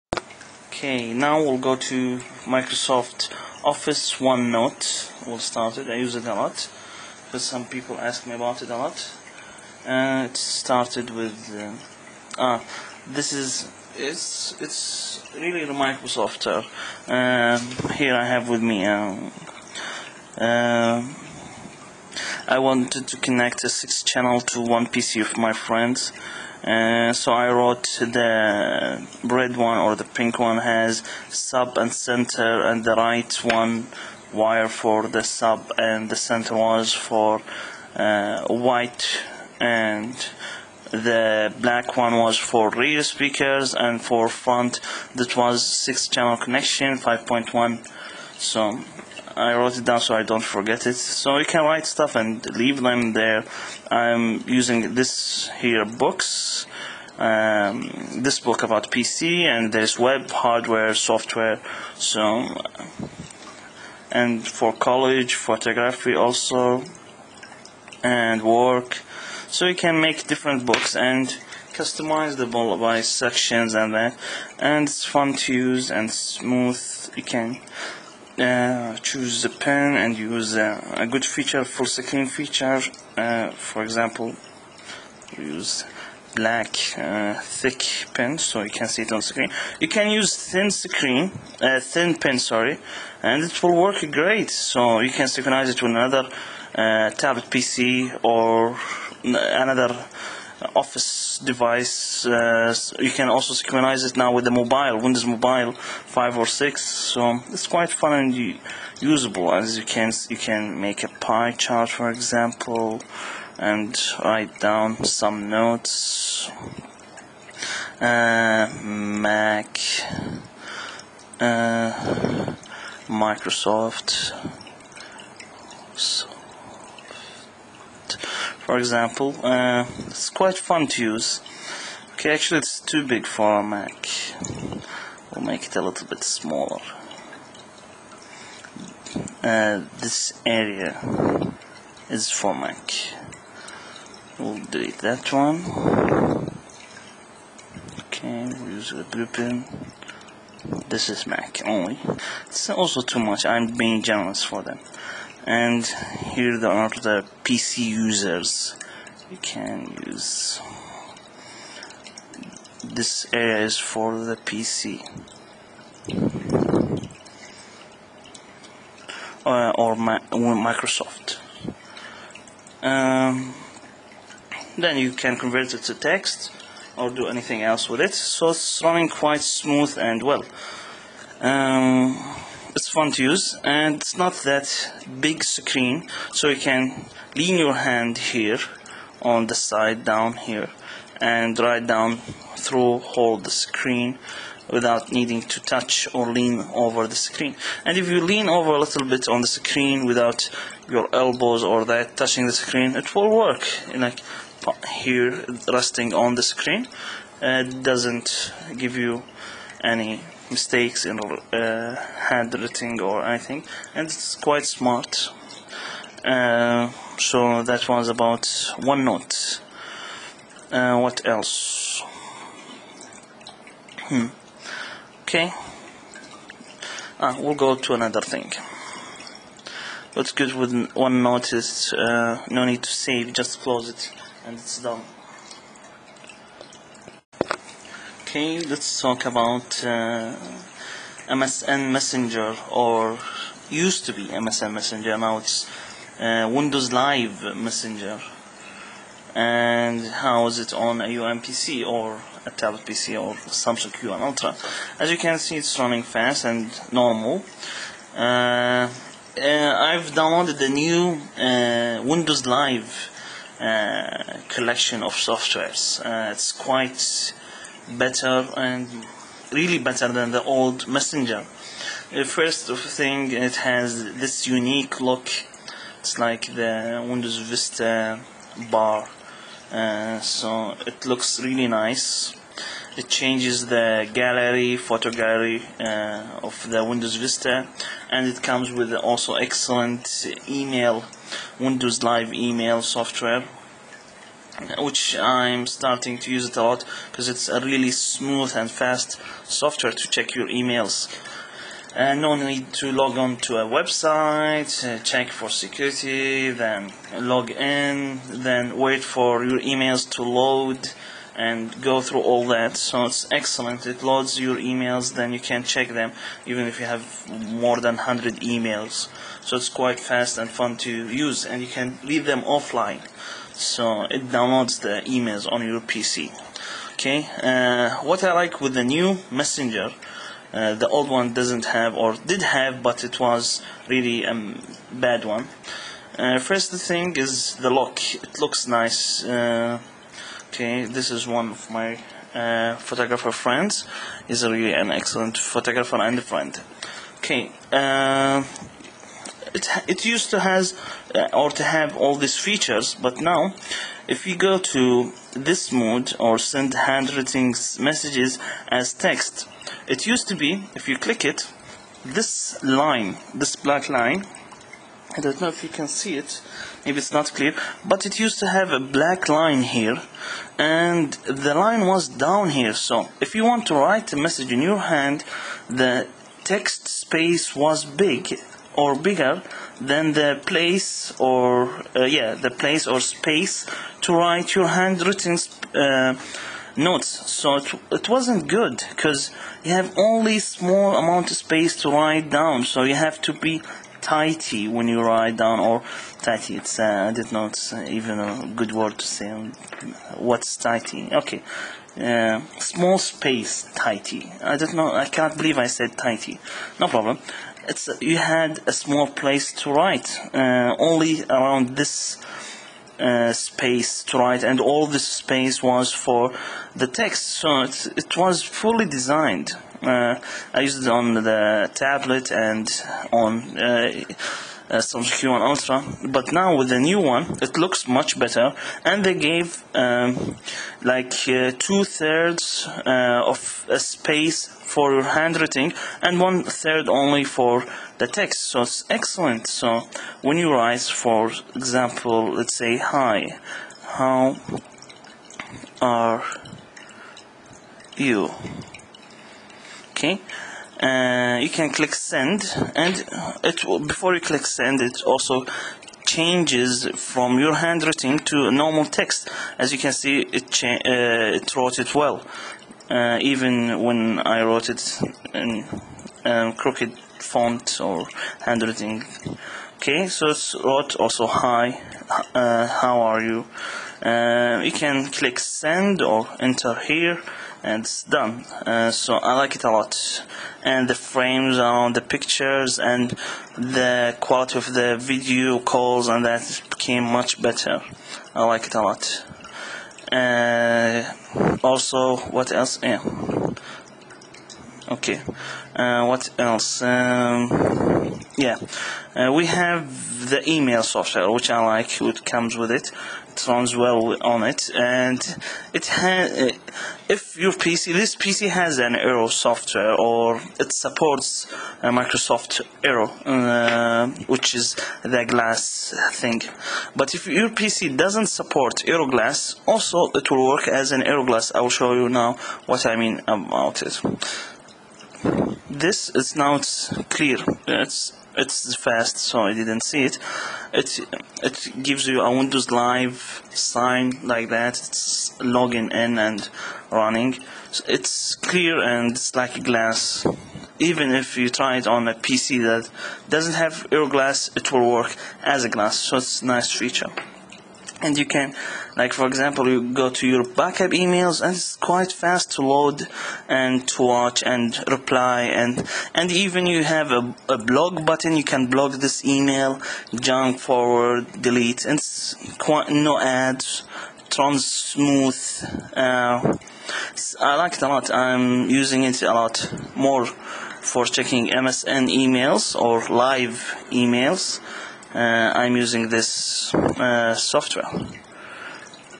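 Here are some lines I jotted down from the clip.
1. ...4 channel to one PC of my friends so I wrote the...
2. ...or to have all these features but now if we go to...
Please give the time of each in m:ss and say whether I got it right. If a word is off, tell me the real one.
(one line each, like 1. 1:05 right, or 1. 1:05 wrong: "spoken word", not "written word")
1. 0:23 wrong: "6", not "4"
2. 5:51 right.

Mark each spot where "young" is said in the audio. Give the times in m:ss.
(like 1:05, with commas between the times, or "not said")
not said.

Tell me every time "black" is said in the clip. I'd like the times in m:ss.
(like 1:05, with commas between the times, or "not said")
0:41, 1:26, 6:03, 6:08.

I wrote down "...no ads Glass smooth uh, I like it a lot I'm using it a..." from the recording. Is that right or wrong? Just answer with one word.
wrong.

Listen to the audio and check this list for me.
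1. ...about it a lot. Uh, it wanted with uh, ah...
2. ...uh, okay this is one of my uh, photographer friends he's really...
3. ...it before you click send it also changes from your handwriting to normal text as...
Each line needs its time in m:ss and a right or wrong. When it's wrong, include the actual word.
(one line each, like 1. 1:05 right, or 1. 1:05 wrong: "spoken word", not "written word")
1. 0:08 wrong: "started", not "wanted"
2. 5:39 right
3. 7:33 right.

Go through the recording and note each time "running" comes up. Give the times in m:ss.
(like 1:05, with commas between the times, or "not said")
2:58, 4:15, 8:56.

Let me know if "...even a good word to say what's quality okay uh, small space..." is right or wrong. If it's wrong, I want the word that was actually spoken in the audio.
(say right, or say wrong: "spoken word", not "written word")
wrong: "tighty", not "quality".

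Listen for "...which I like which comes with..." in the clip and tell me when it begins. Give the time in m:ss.
8:21.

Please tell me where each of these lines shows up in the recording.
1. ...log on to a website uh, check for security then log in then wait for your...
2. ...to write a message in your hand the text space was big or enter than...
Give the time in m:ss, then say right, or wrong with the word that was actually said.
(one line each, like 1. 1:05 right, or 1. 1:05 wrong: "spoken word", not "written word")
1. 5:02 right
2. 6:13 wrong: "bigger", not "enter".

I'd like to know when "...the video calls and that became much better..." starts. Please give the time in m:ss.
8:04.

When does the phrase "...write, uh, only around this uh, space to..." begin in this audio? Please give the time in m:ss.
6:49.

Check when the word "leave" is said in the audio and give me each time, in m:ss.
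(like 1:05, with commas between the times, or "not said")
0:52, 5:22.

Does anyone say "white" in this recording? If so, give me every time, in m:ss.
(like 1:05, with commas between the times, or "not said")
0:38.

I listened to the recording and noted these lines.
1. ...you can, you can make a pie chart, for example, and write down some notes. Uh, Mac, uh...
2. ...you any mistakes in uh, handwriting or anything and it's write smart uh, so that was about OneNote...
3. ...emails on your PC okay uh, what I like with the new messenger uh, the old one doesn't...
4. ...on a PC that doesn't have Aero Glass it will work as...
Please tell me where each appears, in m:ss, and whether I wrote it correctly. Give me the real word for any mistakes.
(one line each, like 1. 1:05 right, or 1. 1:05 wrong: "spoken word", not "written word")
1. 1:49 right
2. 3:28 wrong: "quite", not "write"
3. 5:25 right
4. 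9:01 right.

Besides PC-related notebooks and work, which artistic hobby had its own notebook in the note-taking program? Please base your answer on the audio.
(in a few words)
Photography.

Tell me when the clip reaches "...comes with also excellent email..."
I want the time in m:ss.
4:48.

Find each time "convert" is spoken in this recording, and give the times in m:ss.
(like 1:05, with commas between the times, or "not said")
2:55.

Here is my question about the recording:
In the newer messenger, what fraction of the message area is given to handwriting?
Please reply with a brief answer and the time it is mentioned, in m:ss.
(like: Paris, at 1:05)
Two-thirds, at 7:11.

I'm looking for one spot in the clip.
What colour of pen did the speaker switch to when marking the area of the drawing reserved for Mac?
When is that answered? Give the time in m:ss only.
2:29.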